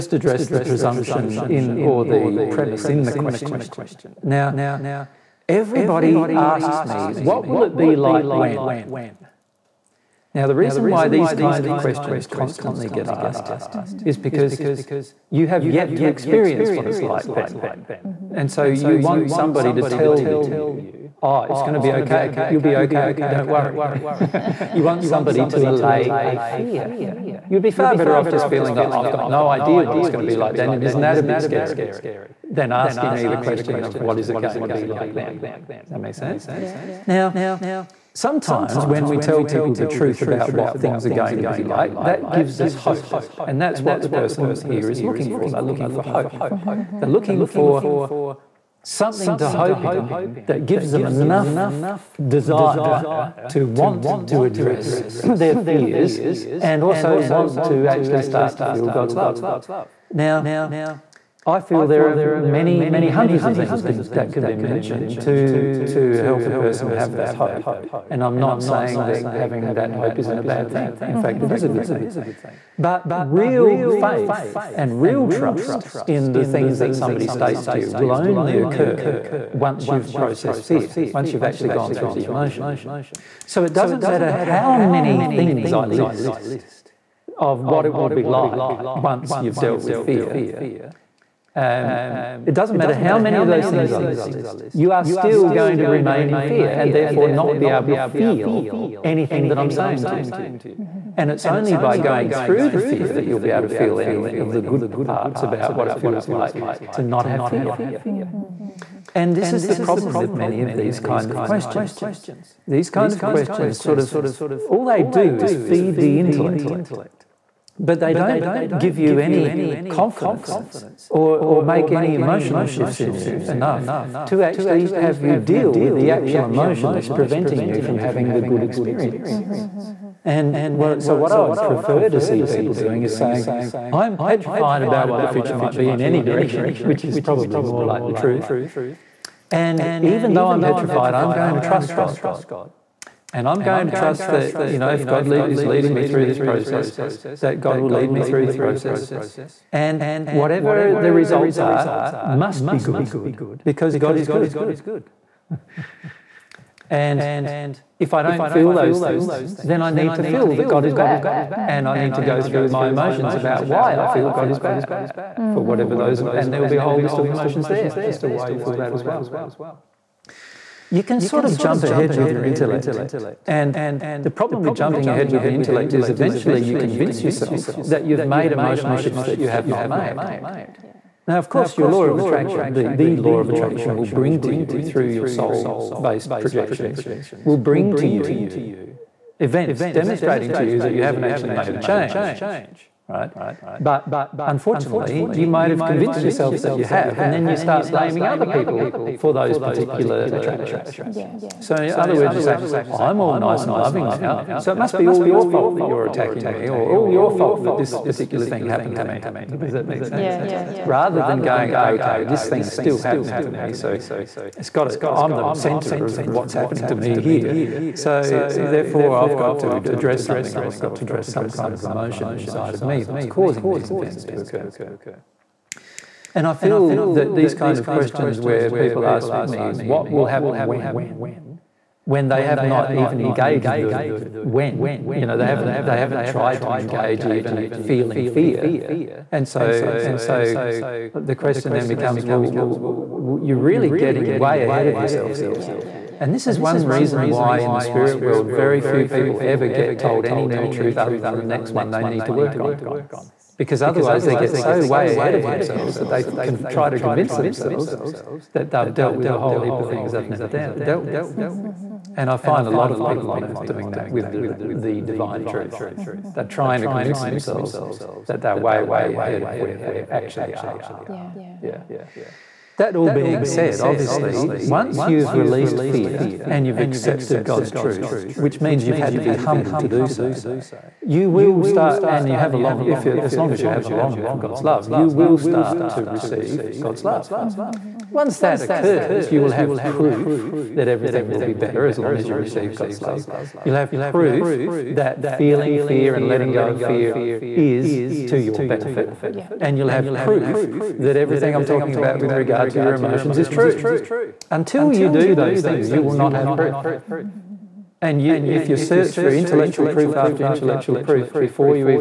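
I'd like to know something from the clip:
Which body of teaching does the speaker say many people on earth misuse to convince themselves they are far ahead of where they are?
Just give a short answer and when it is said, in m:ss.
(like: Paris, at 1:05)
The divine truth, at 4:25.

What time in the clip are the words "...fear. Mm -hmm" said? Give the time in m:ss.
1:47.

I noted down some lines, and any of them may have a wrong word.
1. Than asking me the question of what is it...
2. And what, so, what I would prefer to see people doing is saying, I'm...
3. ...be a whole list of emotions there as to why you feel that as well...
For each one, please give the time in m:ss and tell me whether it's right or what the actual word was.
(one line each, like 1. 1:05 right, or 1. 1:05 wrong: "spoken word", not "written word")
1. 0:32 right
2. 2:10 right
3. 2:46 right.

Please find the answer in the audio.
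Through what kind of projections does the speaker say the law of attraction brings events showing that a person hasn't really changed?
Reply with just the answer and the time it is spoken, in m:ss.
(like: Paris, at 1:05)
Soul based projections, at 3:05.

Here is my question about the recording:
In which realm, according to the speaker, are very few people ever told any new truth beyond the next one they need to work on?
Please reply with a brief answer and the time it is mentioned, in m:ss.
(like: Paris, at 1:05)
The spirit world, at 4:07.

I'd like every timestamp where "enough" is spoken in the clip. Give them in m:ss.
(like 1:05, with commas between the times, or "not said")
0:51, 2:03.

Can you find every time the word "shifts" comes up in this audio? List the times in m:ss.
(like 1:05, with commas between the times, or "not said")
2:02, 2:58.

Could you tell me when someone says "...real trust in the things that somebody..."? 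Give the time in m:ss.
1:14.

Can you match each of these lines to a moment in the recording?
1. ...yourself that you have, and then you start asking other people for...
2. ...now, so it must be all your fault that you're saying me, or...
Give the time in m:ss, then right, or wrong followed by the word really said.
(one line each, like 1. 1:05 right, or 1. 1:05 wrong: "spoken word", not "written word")
1. 3:16 wrong: "blaming", not "asking"
2. 3:24 wrong: "attacking", not "saying".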